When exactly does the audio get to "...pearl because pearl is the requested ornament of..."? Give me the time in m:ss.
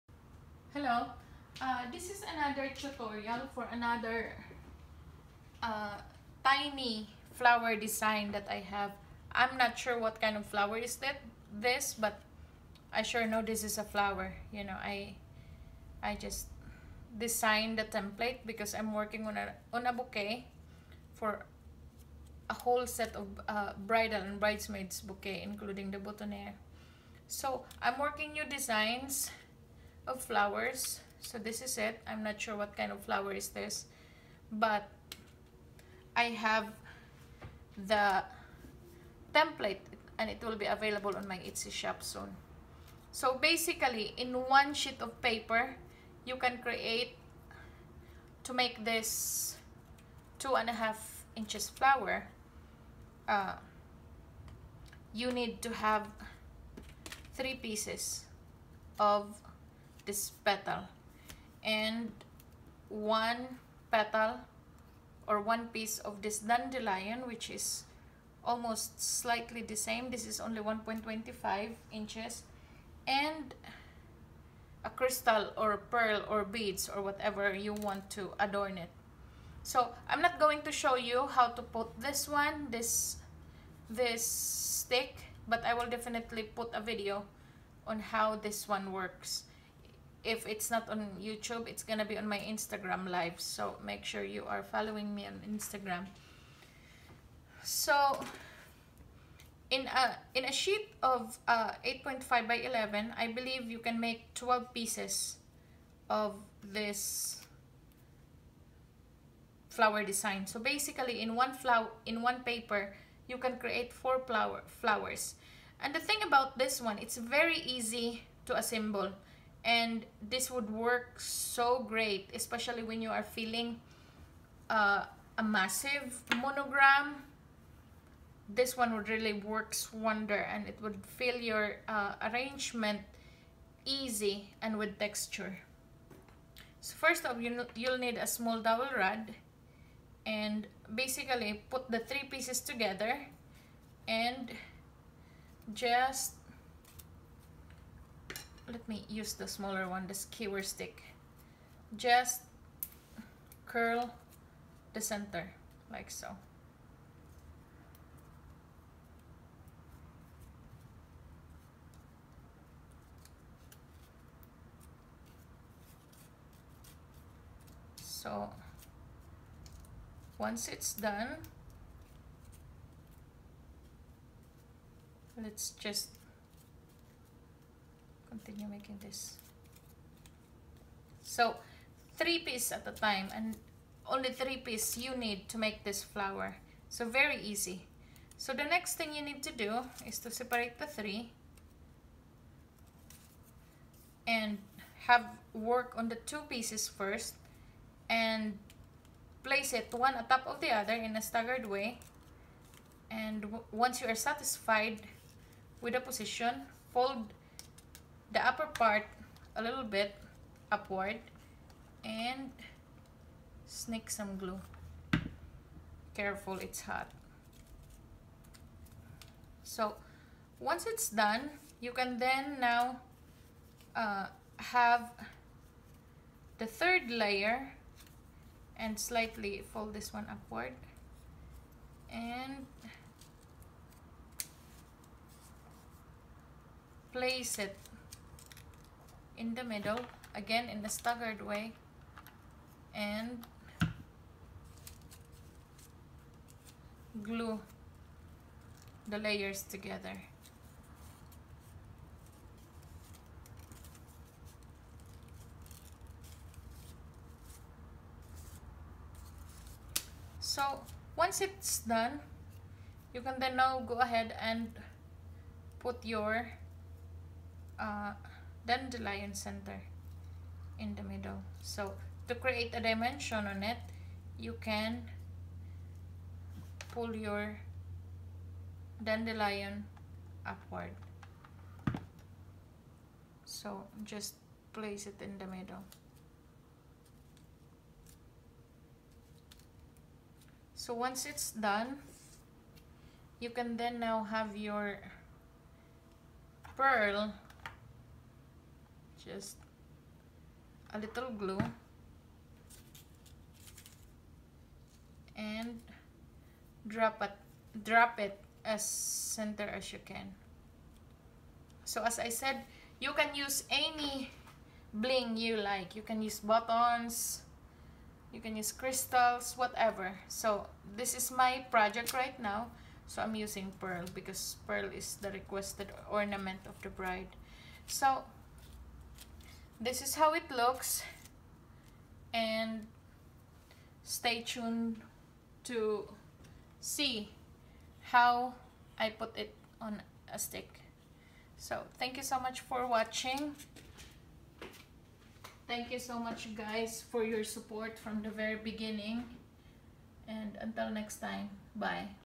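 5:23.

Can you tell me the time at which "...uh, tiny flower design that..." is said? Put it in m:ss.
0:05.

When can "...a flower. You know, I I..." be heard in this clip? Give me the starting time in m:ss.
0:13.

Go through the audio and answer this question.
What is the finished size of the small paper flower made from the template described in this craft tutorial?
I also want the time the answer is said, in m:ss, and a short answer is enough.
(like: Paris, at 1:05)
2.5 inches, at 0:50.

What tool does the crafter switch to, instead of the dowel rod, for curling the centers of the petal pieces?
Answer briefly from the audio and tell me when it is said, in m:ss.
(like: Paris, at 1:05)
skewer stick, at 2:30.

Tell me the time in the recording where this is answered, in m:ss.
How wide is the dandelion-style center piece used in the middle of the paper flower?
1:10.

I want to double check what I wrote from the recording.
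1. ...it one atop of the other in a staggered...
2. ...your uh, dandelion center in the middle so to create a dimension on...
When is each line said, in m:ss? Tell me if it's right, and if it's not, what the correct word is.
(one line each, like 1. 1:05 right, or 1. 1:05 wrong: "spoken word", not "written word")
1. 3:19 right
2. 4:26 right.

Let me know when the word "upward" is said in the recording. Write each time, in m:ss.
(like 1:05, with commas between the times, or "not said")
3:30, 3:50, 4:40.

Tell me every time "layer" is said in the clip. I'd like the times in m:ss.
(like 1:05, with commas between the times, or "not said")
3:47, 4:09.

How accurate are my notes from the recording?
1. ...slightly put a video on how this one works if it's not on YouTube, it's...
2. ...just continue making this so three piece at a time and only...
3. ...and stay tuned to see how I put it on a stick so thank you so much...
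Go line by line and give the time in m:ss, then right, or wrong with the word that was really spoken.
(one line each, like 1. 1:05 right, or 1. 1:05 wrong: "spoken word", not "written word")
1. 1:25 wrong: "definitely", not "slightly"
2. 2:55 right
3. 5:32 right.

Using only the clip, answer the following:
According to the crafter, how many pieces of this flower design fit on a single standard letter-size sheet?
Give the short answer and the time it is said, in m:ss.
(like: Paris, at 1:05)
12, at 1:44.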